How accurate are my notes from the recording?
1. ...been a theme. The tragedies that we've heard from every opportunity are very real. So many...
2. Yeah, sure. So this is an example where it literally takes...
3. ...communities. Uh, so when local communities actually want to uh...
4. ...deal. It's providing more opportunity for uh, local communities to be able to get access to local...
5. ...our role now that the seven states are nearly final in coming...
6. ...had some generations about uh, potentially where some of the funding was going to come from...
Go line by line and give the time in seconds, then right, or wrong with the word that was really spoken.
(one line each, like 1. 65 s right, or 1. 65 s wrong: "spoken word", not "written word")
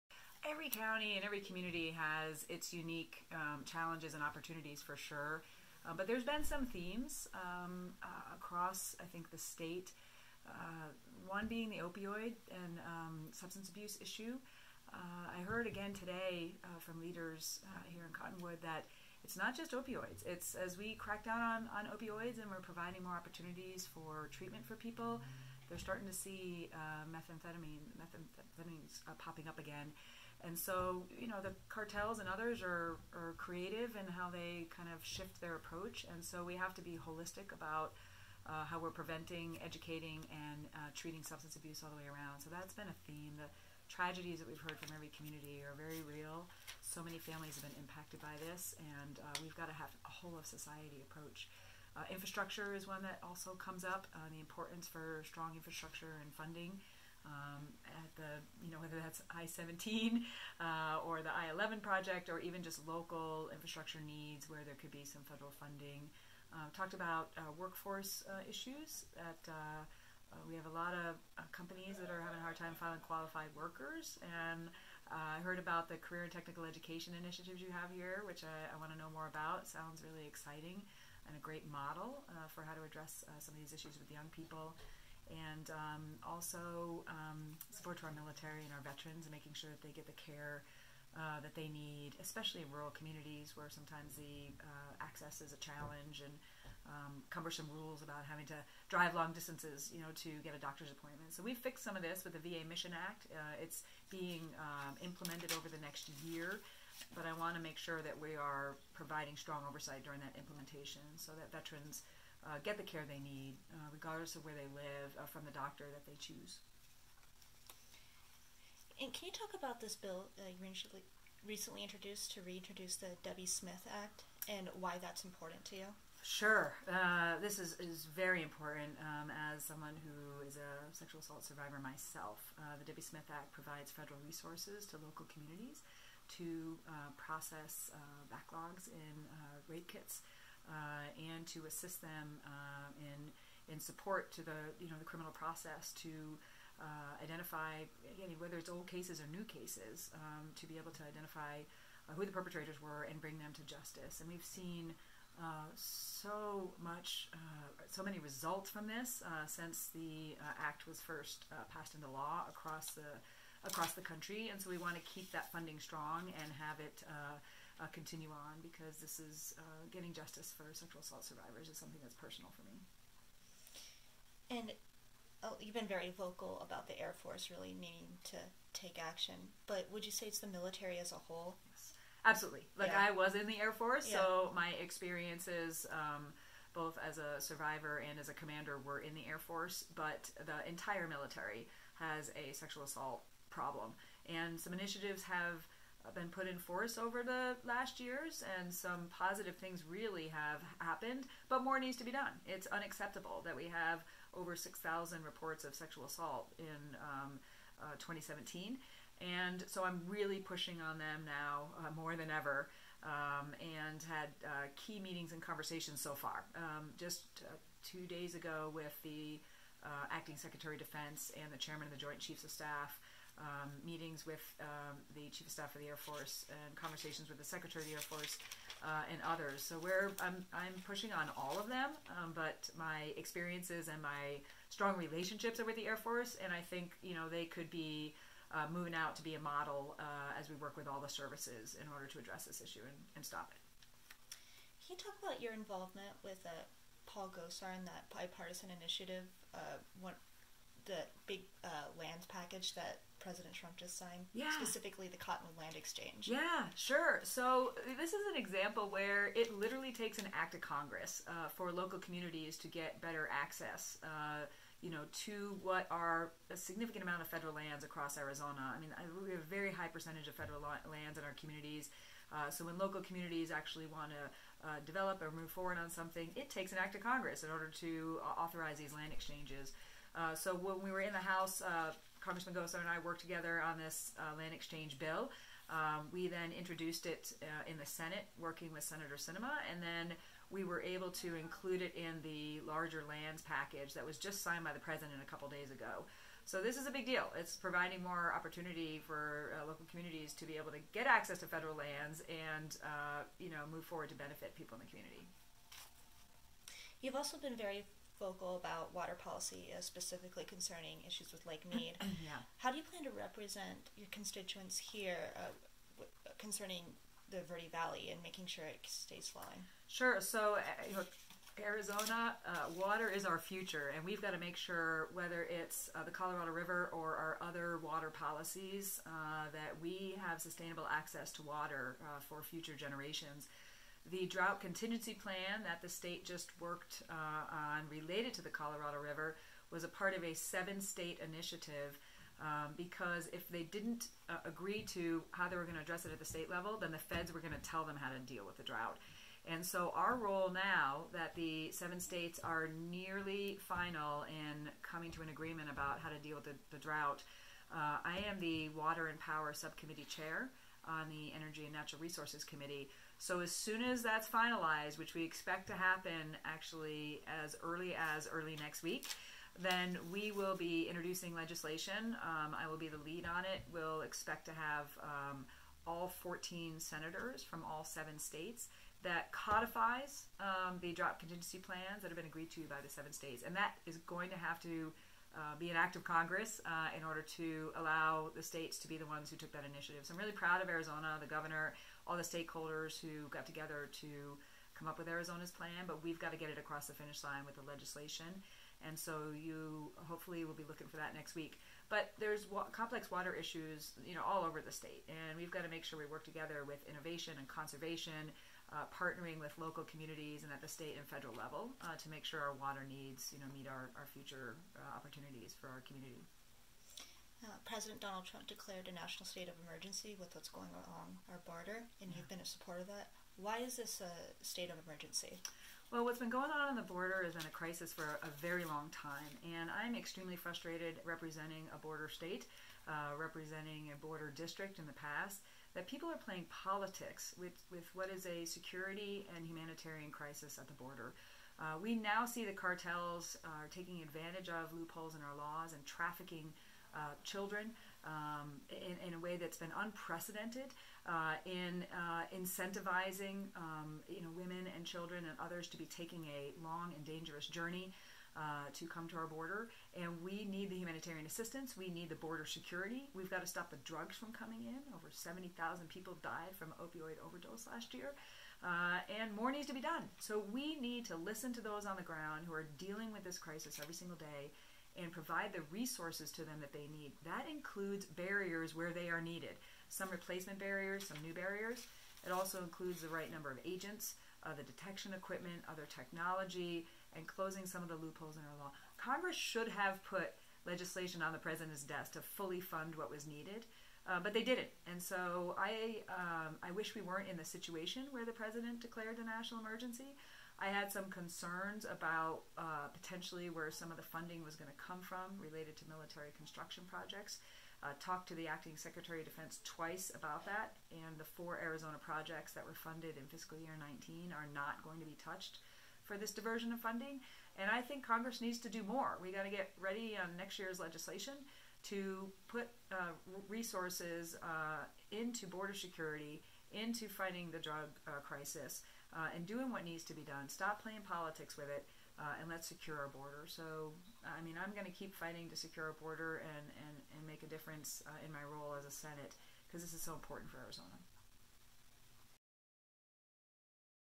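1. 42 s wrong: "community", not "opportunity"
2. 256 s right
3. 271 s right
4. 297 s wrong: "federal", not "local"
5. 349 s right
6. 500 s wrong: "concerns", not "generations".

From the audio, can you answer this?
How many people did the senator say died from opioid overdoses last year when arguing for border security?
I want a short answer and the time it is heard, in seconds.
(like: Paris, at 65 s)
Over 70,000, at 464 s.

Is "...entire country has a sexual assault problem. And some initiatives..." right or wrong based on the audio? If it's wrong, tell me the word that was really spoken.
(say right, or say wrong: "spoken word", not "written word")
wrong: "military", not "country".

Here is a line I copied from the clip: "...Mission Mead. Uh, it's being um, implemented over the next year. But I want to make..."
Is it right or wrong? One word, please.
wrong.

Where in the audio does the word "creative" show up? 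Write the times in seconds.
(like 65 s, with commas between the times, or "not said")
33 s.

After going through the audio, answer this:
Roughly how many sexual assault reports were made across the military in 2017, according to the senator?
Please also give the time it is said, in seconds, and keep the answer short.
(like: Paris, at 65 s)
Over 6,000, at 204 s.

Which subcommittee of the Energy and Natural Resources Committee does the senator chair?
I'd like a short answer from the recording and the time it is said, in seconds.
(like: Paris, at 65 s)
Water and Power Subcommittee, at 358 s.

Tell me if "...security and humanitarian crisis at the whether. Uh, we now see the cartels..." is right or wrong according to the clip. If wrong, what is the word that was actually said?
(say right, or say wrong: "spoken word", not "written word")
wrong: "border", not "whether".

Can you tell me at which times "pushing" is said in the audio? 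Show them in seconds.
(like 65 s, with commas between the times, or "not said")
210 s, 230 s.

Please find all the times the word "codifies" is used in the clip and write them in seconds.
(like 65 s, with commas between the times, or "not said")
379 s.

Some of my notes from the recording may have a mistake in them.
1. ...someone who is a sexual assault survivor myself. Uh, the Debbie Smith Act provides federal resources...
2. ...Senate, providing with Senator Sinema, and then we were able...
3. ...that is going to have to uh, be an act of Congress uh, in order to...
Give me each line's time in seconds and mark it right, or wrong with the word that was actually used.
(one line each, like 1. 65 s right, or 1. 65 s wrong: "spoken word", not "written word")
1. 129 s right
2. 287 s wrong: "working", not "providing"
3. 383 s right.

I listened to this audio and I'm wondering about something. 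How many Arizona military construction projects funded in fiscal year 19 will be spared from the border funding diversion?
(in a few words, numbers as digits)
4.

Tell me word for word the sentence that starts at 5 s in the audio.
Uh, but there's been some themes um, uh, across, I think, the state.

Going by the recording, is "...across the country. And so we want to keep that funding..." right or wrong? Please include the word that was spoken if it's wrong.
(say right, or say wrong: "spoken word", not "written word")
right.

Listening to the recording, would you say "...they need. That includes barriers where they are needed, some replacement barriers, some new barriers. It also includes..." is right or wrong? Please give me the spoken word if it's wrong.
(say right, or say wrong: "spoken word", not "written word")
right.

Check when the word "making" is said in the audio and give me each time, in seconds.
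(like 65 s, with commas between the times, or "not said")
89 s, 318 s.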